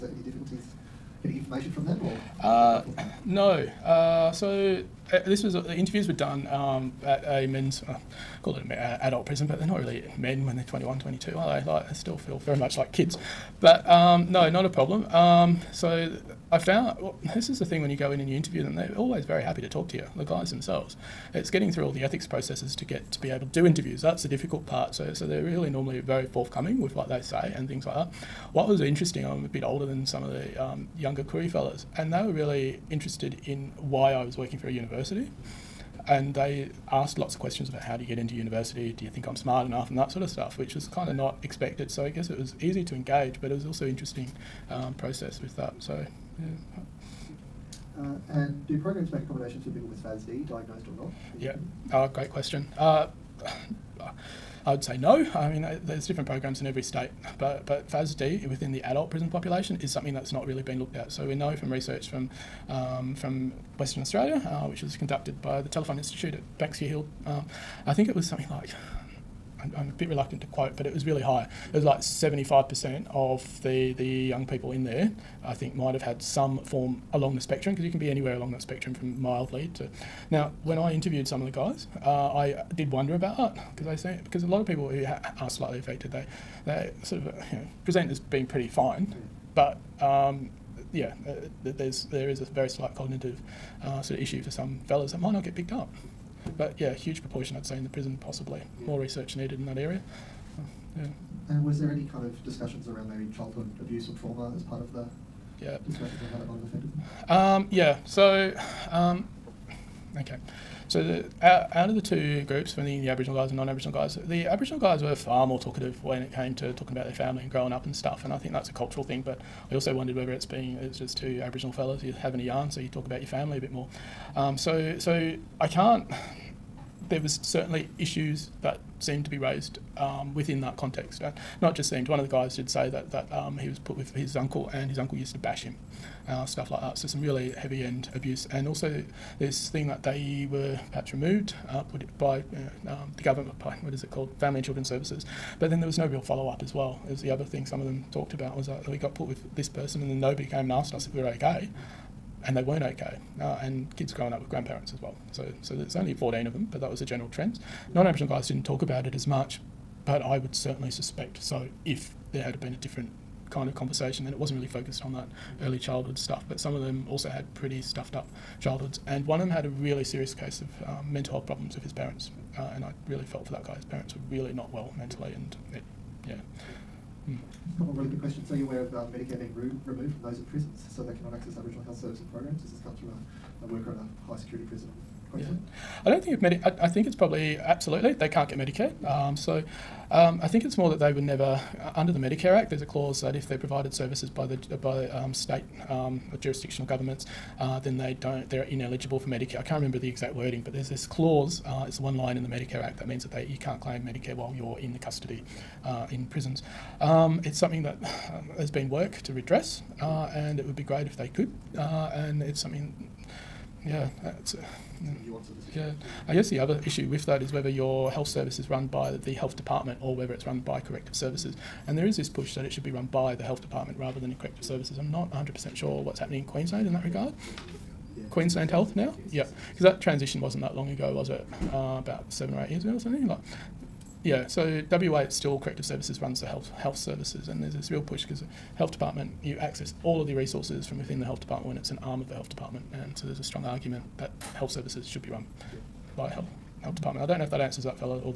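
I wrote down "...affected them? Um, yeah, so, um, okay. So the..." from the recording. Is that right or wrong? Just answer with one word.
right.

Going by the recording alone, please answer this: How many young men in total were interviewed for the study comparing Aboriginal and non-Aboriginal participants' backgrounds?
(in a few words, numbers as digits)
14.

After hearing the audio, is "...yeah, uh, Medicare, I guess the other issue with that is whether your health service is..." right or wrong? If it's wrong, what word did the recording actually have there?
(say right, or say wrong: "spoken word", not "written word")
wrong: "Yeah", not "Medicare".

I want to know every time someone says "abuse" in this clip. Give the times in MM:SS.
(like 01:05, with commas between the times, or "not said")
01:43, 02:18.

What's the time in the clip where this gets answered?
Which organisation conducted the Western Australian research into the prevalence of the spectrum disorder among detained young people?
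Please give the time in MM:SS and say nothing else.
01:05.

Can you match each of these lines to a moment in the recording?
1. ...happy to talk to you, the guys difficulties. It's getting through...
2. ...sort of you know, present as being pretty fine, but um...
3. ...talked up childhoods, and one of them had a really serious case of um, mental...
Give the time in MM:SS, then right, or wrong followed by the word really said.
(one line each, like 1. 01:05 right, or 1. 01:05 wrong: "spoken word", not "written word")
1. 00:19 wrong: "themselves", not "difficulties"
2. 01:27 right
3. 02:47 wrong: "stuffed", not "talked".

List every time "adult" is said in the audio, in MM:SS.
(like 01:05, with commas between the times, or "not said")
00:09, 00:58.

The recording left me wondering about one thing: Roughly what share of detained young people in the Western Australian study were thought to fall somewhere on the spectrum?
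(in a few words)
75%.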